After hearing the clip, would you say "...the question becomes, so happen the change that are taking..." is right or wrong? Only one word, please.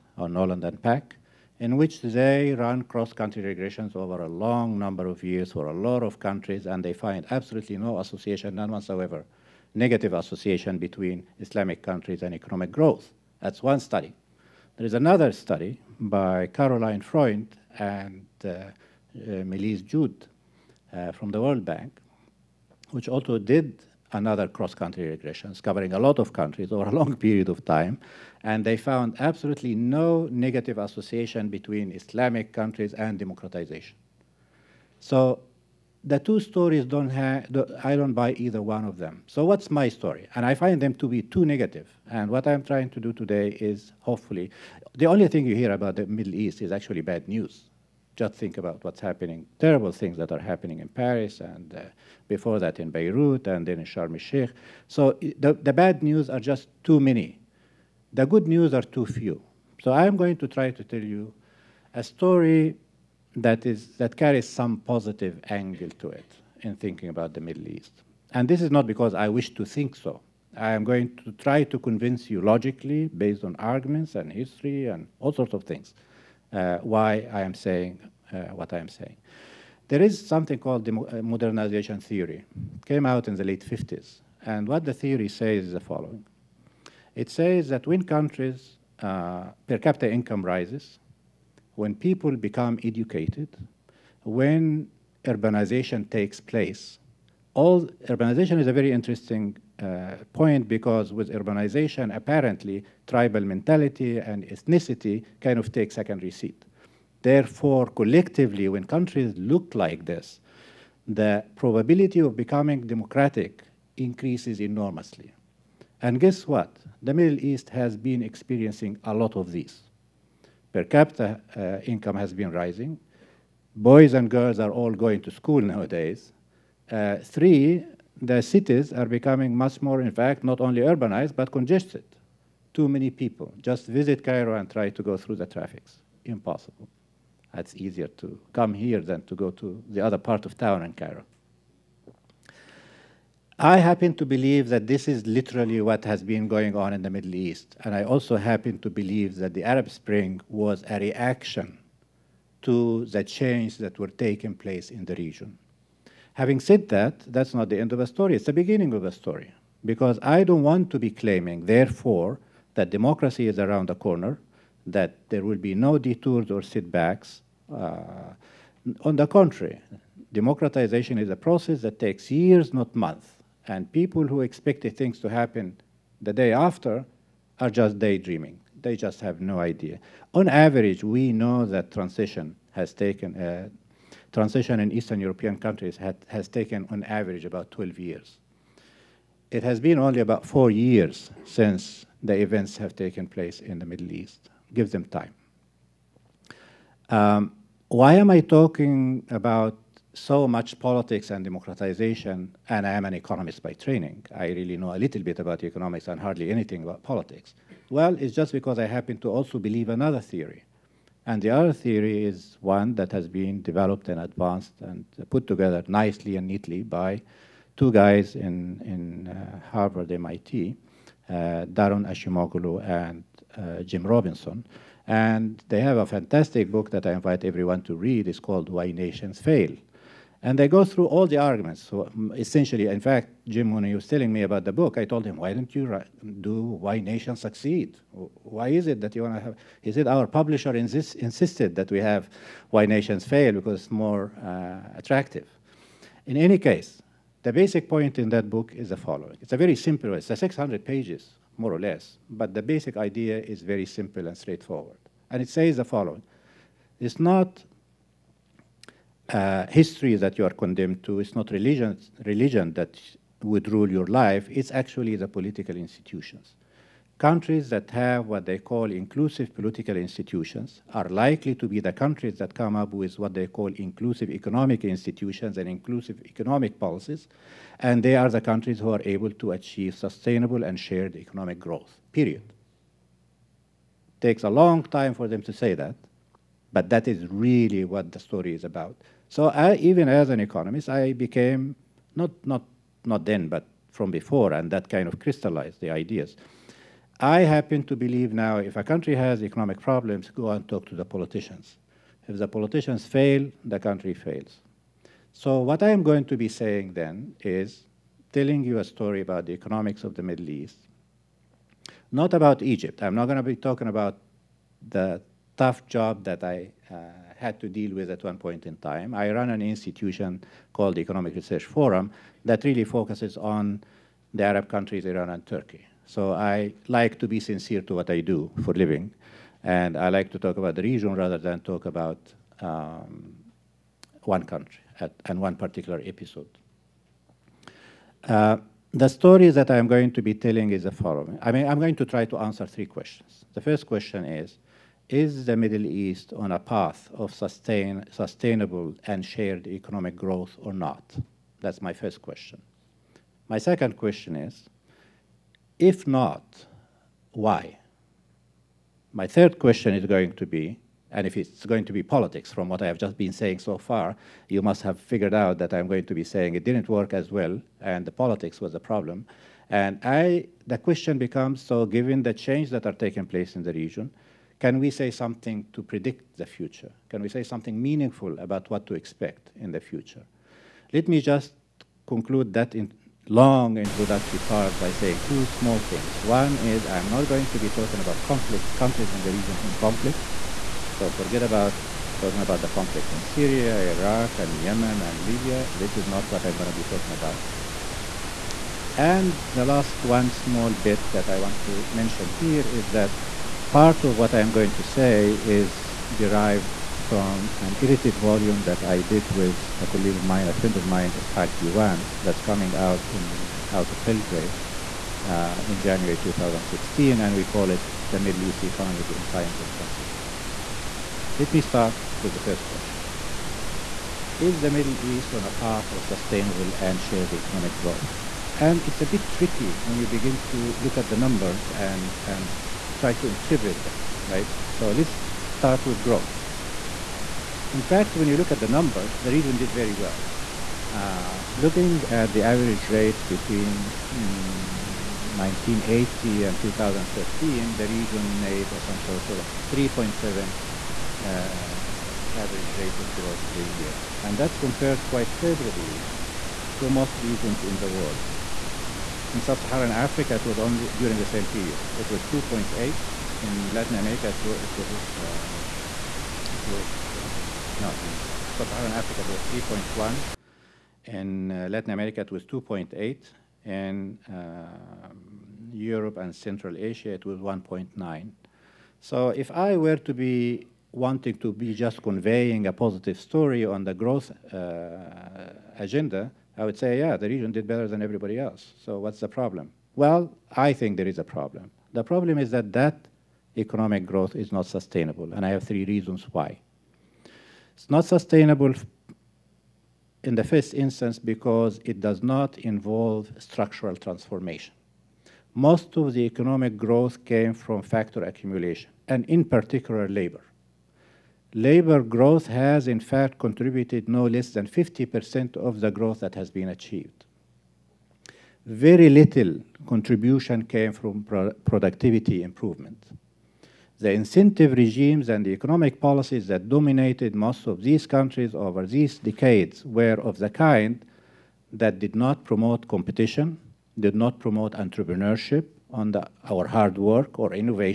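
wrong.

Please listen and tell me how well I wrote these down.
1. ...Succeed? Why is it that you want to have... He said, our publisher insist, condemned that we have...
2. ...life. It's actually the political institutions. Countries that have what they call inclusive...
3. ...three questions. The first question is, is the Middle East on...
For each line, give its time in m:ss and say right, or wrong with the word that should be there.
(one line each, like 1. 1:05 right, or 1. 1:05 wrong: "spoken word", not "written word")
1. 3:57 wrong: "insisted", not "condemned"
2. 4:24 right
3. 5:42 right.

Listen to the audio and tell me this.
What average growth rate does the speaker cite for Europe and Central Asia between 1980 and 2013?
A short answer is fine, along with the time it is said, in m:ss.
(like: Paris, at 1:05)
1.9, at 7:57.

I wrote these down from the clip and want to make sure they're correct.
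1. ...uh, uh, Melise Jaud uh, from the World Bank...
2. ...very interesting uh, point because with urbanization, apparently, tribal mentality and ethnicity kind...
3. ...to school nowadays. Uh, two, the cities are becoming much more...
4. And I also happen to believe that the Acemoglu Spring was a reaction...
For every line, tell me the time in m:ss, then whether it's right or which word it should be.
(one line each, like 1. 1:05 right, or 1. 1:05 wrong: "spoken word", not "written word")
1. 0:18 right
2. 1:38 right
3. 2:05 wrong: "three", not "two"
4. 2:27 wrong: "Arab", not "Acemoglu".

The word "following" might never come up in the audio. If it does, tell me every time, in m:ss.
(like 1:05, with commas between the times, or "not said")
1:25, 4:08, 4:15, 5:40.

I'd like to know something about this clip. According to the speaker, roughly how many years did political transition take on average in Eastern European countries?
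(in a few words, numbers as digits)
12 years.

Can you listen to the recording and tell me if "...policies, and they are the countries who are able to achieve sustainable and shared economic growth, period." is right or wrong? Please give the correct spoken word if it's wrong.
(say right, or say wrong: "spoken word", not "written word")
right.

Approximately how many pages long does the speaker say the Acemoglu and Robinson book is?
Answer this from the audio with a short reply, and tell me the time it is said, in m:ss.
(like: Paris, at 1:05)
600, at 4:10.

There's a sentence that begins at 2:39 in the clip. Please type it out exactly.
Because I don't want to be claiming, therefore, that democracy is around the corner, that there will be no detours or setbacks.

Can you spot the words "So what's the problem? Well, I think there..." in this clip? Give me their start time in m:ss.
8:08.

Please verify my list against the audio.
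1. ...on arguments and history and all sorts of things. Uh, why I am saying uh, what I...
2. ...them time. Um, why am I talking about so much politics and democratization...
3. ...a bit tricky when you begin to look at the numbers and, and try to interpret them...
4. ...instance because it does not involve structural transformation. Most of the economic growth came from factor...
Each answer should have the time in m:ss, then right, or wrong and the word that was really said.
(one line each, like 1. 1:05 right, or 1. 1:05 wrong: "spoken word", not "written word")
1. 1:13 right
2. 3:14 right
3. 7:09 right
4. 8:20 right.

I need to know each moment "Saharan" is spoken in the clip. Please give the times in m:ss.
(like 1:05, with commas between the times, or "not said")
7:39, 7:48.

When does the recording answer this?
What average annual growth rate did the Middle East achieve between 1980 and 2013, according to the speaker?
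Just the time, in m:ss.
7:29.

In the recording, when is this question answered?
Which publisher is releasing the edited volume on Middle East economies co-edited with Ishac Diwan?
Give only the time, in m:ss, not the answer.
6:54.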